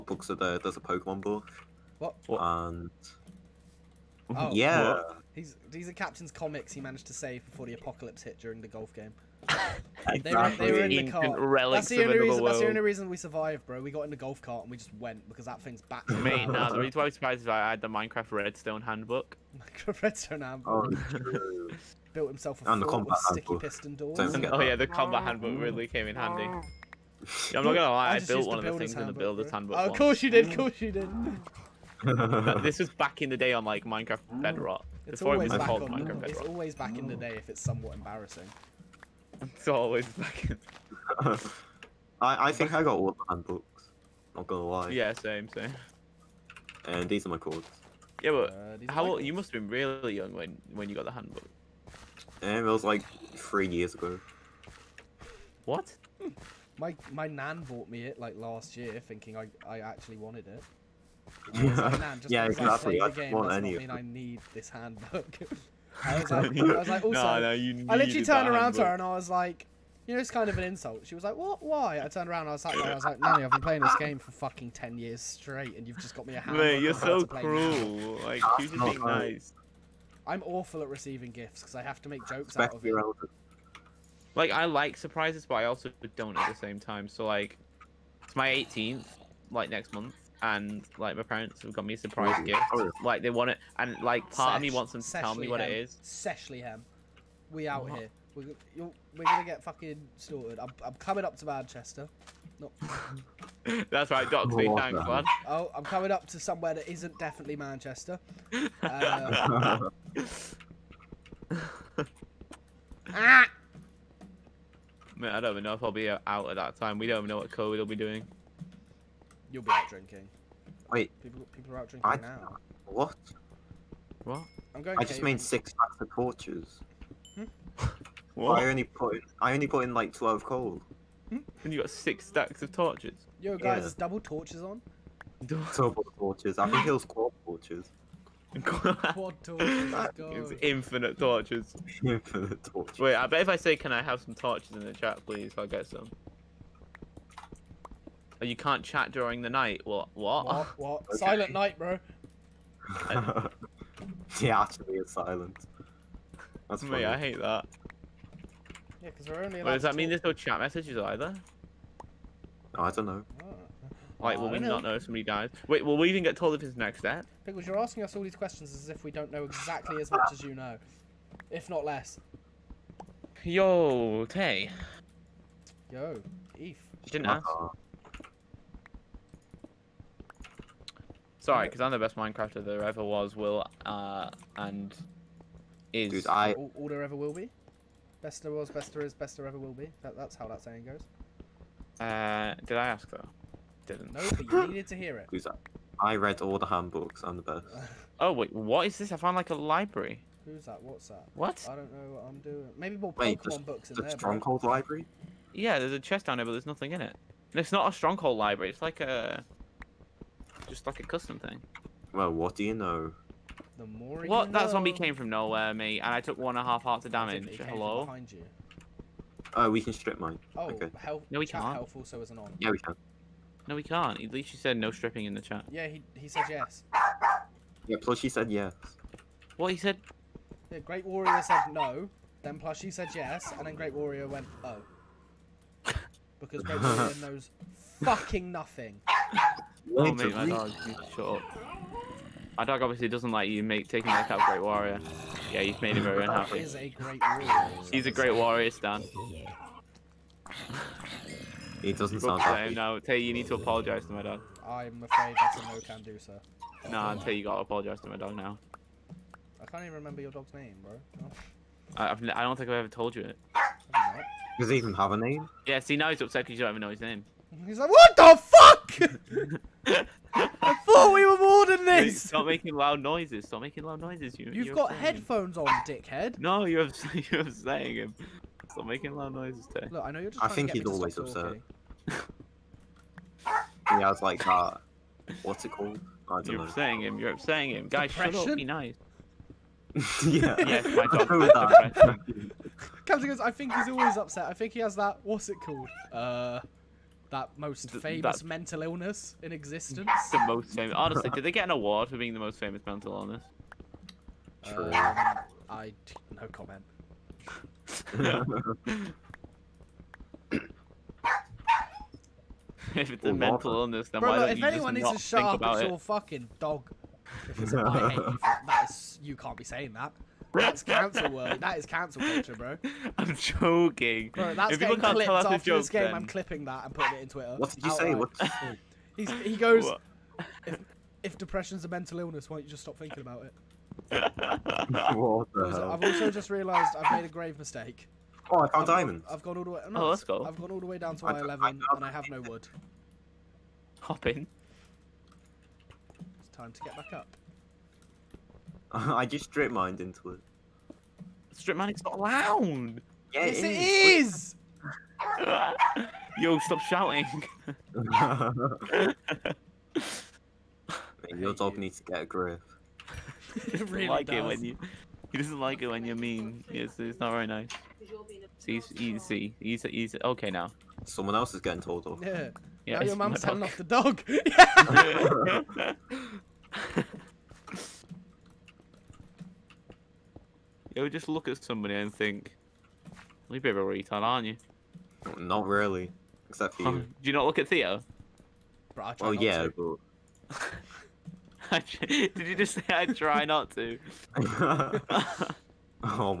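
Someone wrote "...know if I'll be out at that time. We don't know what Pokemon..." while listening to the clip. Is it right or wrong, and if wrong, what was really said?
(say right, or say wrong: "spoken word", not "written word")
wrong: "COVID", not "Pokemon".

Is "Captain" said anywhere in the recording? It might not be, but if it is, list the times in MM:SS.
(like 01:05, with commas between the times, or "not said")
00:05, 04:53.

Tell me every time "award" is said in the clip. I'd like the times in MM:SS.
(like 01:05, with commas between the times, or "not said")
05:01.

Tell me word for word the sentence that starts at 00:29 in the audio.
Oh, of course you did, of course you did.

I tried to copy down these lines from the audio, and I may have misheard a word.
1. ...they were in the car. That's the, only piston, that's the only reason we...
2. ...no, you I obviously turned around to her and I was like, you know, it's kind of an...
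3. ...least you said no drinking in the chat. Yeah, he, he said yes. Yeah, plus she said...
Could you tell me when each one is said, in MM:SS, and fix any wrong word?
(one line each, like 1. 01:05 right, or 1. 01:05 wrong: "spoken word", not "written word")
1. 00:10 wrong: "reason", not "piston"
2. 01:07 wrong: "literally", not "obviously"
3. 03:44 wrong: "stripping", not "drinking".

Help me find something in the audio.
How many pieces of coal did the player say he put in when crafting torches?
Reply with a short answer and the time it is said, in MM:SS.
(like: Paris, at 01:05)
12, at 02:10.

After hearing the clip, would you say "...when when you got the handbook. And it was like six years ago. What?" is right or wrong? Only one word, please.
wrong.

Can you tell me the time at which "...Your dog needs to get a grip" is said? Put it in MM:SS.
06:01.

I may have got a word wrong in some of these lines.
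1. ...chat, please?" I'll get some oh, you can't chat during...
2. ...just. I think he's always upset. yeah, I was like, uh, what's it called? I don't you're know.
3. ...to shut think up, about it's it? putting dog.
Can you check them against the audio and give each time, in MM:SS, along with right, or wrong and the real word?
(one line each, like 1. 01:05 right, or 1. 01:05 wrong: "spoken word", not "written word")
1. 02:24 right
2. 04:40 right
3. 05:15 wrong: "fucking", not "putting".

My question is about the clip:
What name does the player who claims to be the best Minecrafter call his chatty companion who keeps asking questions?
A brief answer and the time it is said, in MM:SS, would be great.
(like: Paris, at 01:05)
Pickles, at 02:47.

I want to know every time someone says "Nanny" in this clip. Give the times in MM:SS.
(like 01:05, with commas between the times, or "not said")
01:13.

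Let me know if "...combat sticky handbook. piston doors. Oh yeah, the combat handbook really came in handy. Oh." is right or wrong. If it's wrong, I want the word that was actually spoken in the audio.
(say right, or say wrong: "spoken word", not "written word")
right.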